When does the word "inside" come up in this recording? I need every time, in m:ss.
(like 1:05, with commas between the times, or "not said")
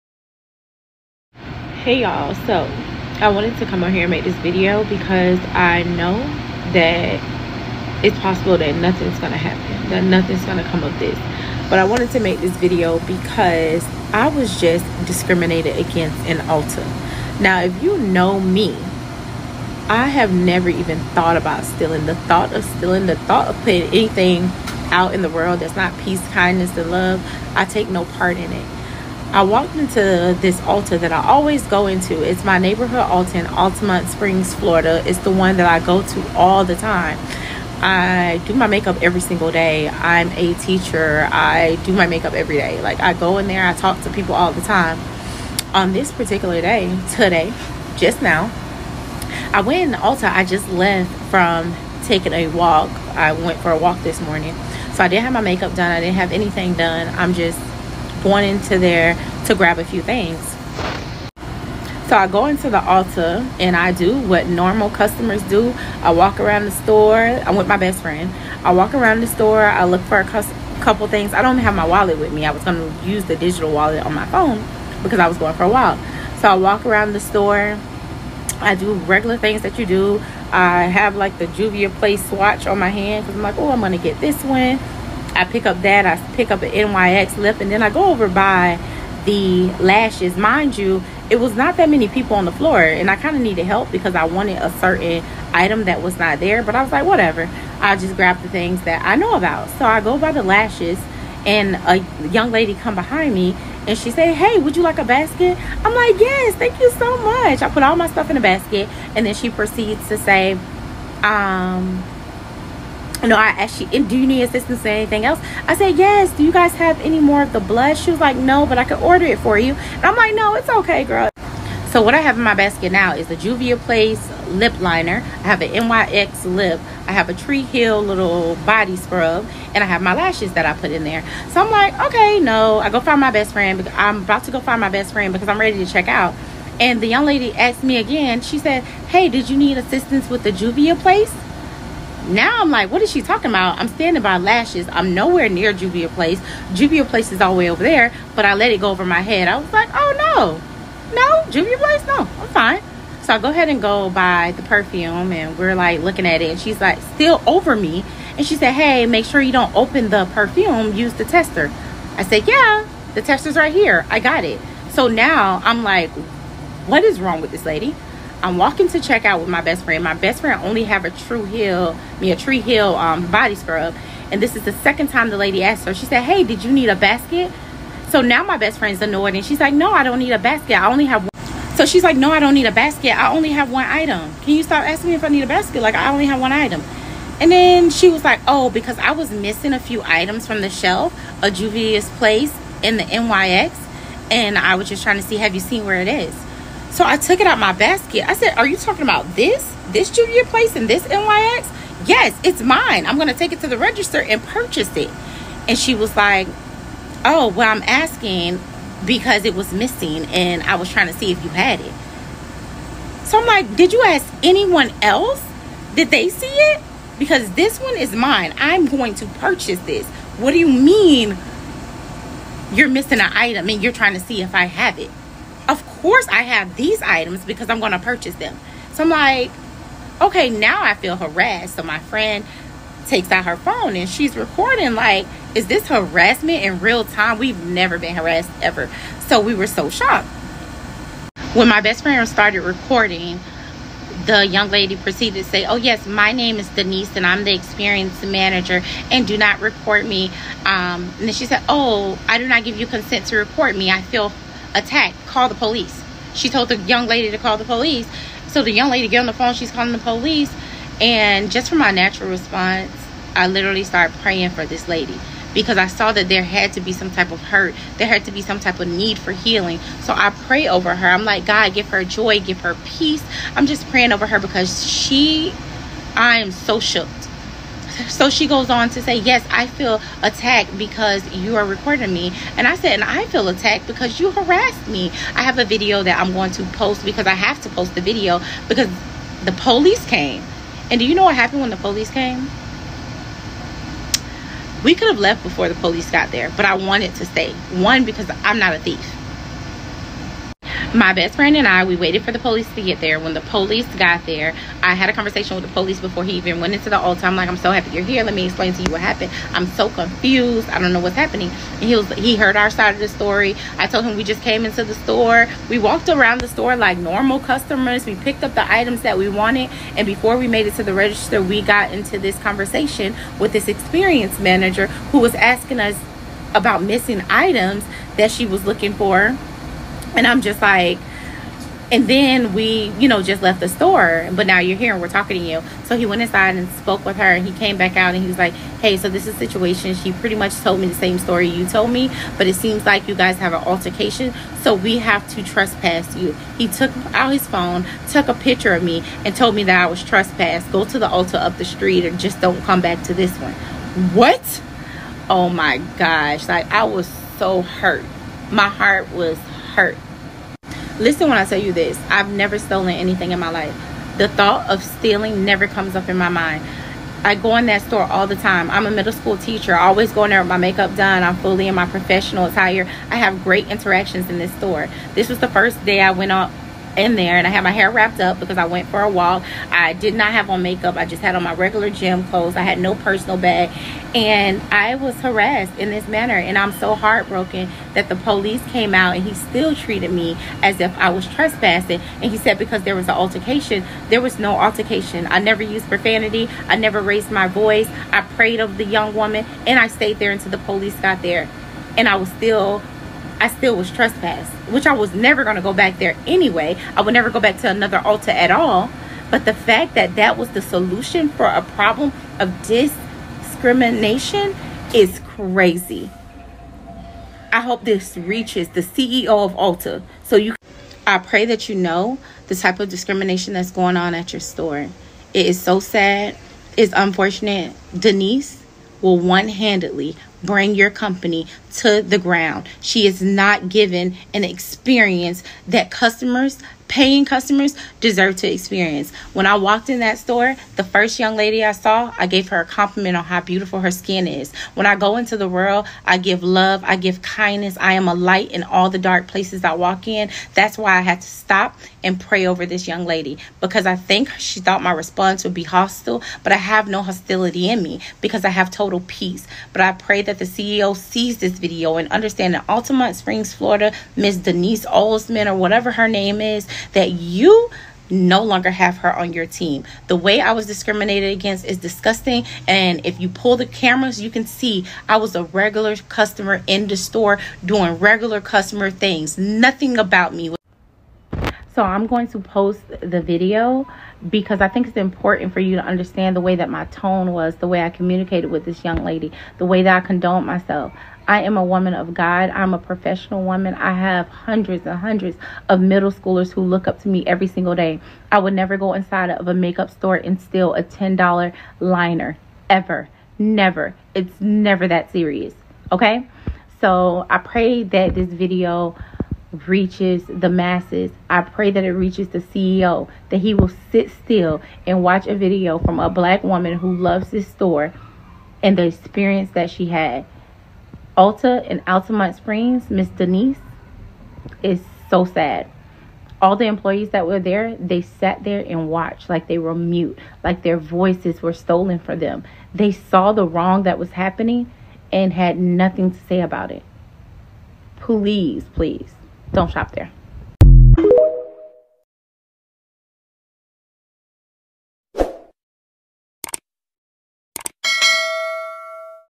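5:36, 8:18.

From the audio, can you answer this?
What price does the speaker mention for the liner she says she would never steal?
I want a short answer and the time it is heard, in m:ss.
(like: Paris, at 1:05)
$10, at 8:20.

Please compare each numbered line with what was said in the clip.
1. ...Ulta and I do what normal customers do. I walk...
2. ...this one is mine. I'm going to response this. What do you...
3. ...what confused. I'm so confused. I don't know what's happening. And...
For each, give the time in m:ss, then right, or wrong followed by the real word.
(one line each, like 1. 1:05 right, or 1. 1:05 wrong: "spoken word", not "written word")
1. 1:02 right
2. 3:37 wrong: "purchase", not "response"
3. 5:08 wrong: "happened", not "confused".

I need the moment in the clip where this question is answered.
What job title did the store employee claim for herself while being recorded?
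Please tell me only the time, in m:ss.
4:07.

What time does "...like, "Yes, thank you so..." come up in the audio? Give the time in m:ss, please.
1:45.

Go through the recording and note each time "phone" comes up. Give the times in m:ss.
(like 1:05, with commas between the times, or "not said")
1:14, 3:53, 4:19, 5:47.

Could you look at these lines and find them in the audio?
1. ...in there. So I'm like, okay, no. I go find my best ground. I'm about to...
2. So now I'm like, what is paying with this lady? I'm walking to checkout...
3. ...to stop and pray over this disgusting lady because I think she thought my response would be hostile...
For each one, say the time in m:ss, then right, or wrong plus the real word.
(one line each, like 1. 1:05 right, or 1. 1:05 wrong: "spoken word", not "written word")
1. 2:10 wrong: "friend", not "ground"
2. 2:44 wrong: "wrong", not "paying"
3. 7:31 wrong: "young", not "disgusting".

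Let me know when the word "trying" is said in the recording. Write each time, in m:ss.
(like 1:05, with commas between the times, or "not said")
3:15, 3:30, 3:43.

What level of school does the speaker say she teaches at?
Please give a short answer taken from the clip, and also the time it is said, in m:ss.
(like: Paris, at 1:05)
Middle school, at 6:08.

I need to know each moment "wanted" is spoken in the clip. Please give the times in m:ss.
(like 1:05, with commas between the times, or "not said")
0:03, 0:11, 1:34, 4:56, 5:19.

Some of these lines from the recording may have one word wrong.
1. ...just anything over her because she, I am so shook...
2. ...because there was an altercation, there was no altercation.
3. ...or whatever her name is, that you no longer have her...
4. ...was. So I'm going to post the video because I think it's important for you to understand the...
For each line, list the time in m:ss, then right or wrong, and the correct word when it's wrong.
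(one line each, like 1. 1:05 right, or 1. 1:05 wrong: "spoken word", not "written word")
1. 4:33 wrong: "praying", not "anything"
2. 6:32 right
3. 7:45 right
4. 8:00 right.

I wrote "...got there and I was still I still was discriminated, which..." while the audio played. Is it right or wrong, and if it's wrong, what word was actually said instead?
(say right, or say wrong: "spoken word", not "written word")
wrong: "trespassed", not "discriminated".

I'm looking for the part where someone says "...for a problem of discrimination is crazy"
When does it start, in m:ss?
6:51.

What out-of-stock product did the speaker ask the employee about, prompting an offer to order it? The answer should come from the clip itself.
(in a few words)
The blood.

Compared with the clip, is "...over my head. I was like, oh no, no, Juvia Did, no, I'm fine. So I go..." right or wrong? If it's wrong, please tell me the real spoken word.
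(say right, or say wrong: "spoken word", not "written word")
wrong: "Place", not "Did".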